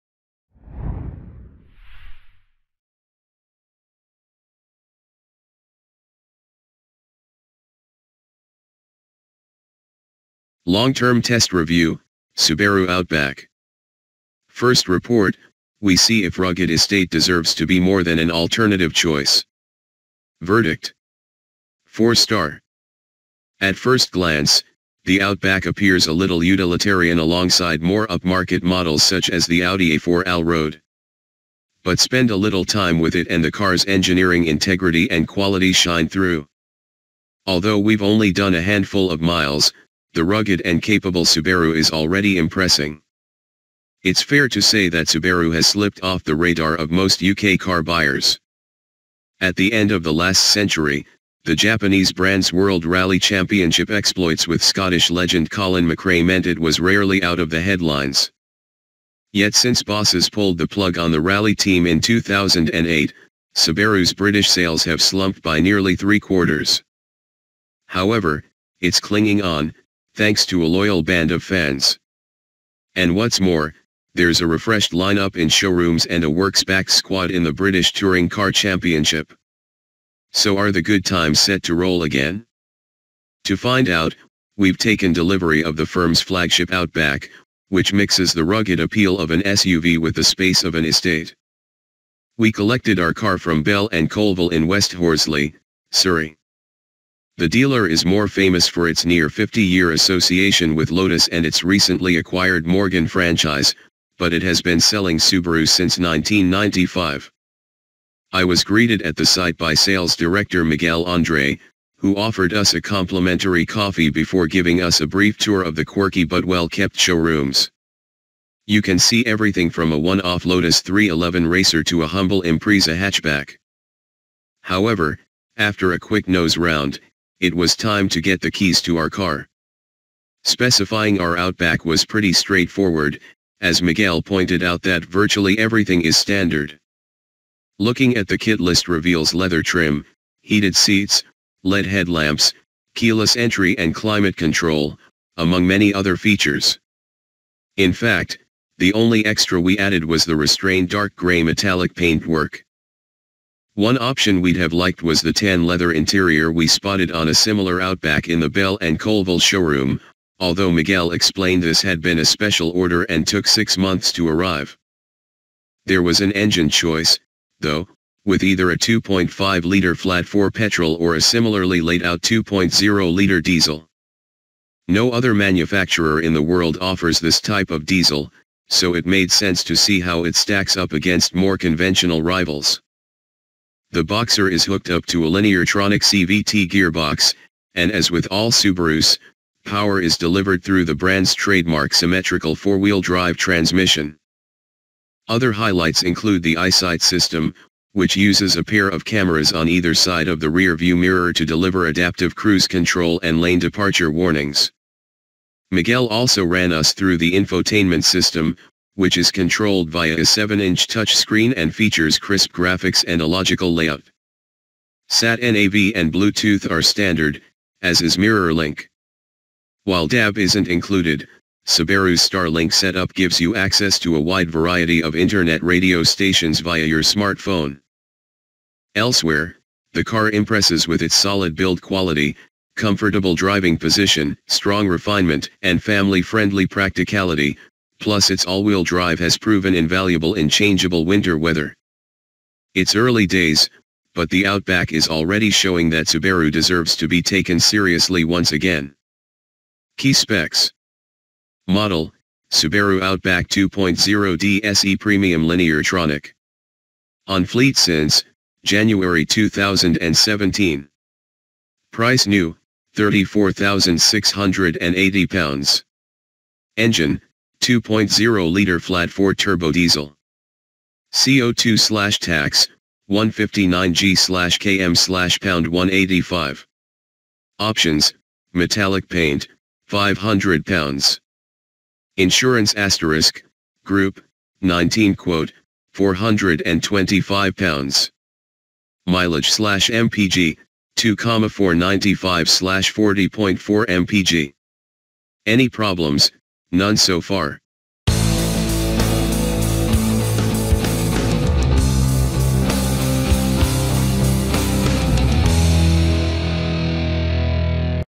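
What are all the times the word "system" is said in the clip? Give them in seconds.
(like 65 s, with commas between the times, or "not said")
197 s, 208 s.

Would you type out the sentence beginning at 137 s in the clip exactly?
Looking at the kit list reveals leather trim, heated seats, LED headlamps, keyless entry and climate control, among many other features.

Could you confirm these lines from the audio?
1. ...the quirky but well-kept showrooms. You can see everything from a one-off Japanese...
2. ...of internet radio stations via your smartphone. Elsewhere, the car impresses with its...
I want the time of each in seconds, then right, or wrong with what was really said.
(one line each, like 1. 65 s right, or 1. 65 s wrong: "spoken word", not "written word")
1. 115 s wrong: "Lotus", not "Japanese"
2. 225 s right.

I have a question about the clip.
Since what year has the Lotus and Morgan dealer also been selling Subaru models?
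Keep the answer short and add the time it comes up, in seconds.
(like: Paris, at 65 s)
1995, at 105 s.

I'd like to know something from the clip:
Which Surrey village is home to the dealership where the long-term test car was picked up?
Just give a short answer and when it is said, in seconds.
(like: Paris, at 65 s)
West Horsley, at 94 s.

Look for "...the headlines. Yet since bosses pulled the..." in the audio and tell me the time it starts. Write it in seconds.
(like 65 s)
57 s.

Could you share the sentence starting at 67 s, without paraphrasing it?
However, it's clinging on, thanks to a loyal band of fans.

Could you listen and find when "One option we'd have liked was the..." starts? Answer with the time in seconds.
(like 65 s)
153 s.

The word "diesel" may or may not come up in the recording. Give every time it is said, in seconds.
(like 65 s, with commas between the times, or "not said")
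173 s, 177 s, 269 s.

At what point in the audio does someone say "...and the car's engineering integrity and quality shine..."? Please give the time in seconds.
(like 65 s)
33 s.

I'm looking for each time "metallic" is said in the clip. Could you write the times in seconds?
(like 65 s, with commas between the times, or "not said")
151 s, 278 s.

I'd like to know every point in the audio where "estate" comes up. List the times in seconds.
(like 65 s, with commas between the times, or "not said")
16 s, 90 s.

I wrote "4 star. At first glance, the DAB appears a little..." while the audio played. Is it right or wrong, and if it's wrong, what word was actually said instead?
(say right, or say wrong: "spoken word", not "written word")
wrong: "Outback", not "DAB".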